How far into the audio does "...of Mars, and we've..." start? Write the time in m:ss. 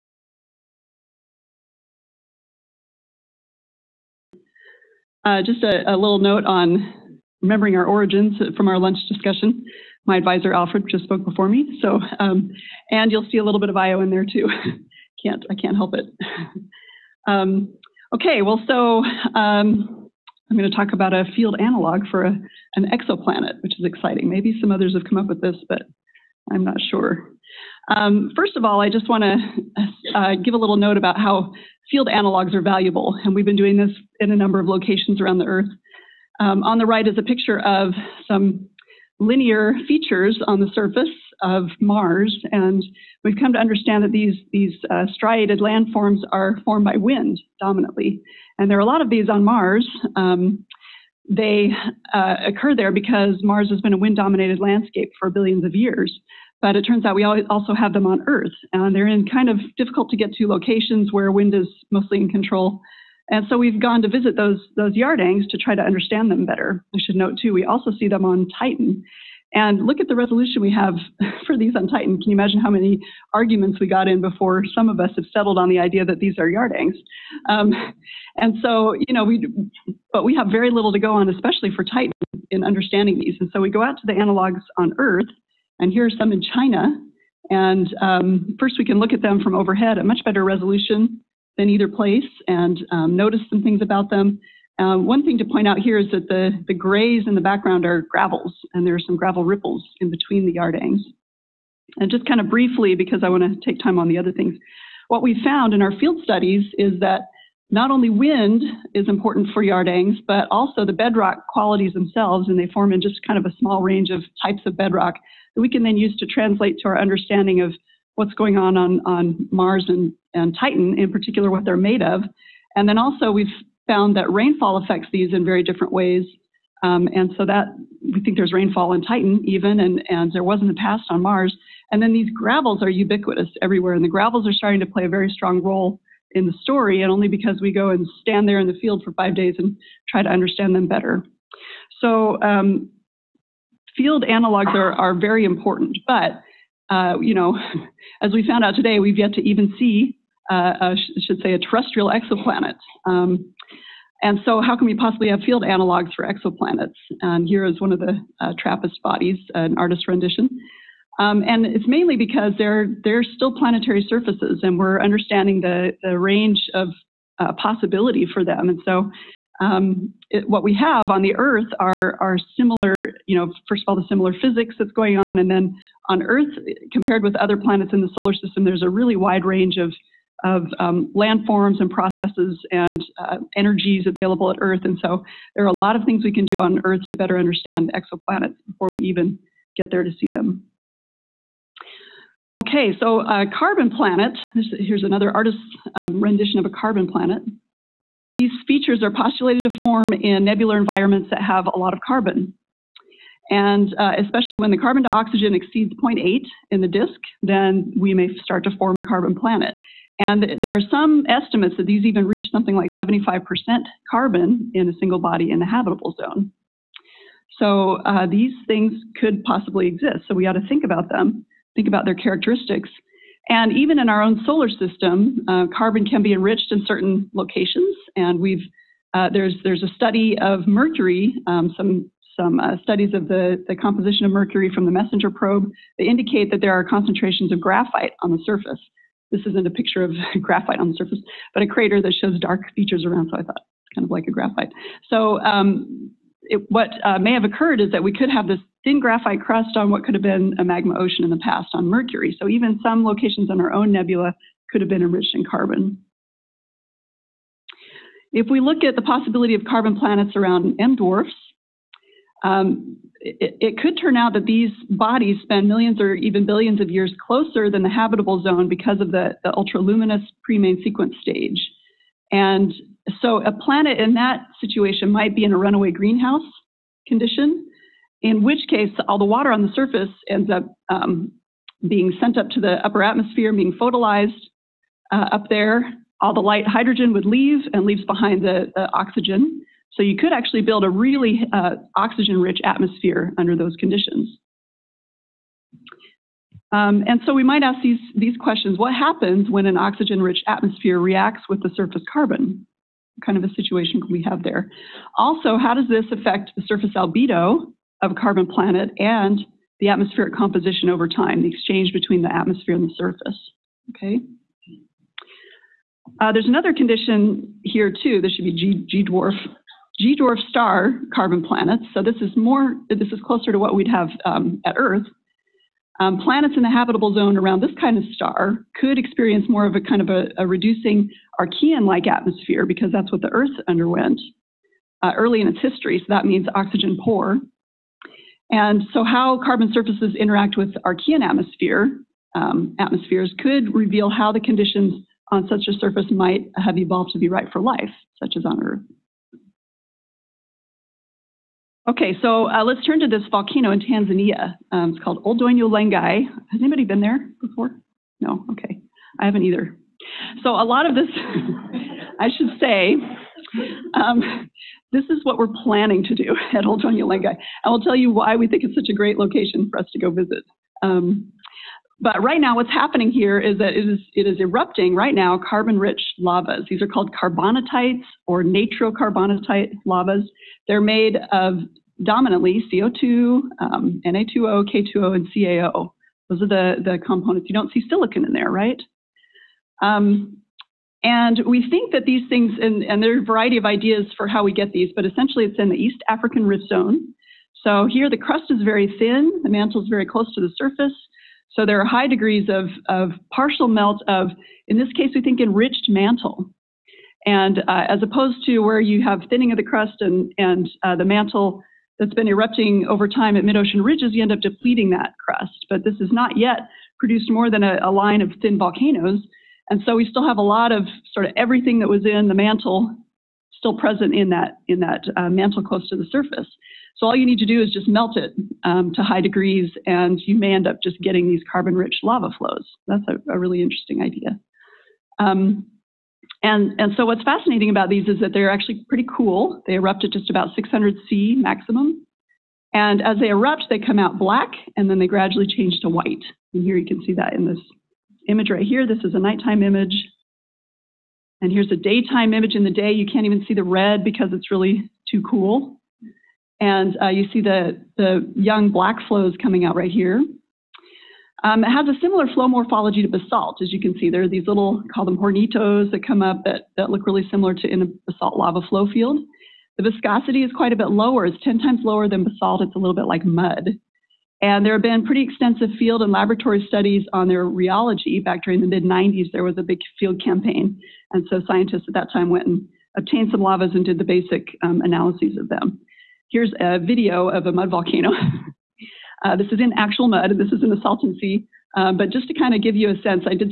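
0:41.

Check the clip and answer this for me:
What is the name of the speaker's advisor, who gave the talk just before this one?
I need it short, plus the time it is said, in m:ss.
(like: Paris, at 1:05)
Alfred, at 0:10.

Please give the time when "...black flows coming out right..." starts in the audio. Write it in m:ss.
7:38.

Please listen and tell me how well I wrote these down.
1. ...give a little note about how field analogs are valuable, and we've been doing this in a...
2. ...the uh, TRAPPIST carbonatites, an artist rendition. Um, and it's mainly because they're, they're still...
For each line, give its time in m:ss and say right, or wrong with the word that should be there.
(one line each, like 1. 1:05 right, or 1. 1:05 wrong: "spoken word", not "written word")
1. 0:30 right
2. 2:37 wrong: "bodies", not "carbonatites".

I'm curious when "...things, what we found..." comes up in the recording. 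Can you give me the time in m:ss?
1:44.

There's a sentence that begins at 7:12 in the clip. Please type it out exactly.
That's a, a really interesting idea.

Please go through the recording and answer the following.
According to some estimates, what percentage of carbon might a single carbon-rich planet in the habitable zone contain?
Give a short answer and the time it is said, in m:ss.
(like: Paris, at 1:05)
75%, at 3:32.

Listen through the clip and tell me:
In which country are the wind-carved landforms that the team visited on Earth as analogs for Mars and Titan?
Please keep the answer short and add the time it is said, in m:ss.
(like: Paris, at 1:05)
China, at 1:26.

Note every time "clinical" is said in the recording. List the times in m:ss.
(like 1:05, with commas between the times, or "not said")
not said.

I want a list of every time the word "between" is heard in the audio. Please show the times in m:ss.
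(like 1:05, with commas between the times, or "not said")
1:40, 5:11.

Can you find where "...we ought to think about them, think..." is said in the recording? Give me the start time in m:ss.
3:40.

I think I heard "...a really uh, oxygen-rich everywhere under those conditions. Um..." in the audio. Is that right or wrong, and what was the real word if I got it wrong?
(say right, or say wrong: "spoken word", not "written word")
wrong: "atmosphere", not "everywhere".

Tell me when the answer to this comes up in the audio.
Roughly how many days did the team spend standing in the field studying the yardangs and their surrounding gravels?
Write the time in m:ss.
2:19.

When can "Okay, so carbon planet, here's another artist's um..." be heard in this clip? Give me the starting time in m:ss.
3:12.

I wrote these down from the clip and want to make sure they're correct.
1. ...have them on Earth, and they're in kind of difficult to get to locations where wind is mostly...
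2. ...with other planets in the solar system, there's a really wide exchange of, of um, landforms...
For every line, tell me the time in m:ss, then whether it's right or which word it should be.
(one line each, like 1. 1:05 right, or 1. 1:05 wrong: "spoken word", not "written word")
1. 0:57 right
2. 2:57 wrong: "range", not "exchange".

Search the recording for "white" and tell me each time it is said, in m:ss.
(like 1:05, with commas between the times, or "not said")
7:25.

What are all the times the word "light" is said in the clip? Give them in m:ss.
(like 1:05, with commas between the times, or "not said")
4:46.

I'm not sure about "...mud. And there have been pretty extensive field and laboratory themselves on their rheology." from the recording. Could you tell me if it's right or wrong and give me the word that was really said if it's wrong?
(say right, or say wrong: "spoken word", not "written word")
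wrong: "studies", not "themselves".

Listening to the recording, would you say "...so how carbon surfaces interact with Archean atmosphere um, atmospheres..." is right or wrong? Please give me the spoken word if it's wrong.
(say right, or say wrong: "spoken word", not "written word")
right.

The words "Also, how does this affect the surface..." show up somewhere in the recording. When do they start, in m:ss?
5:05.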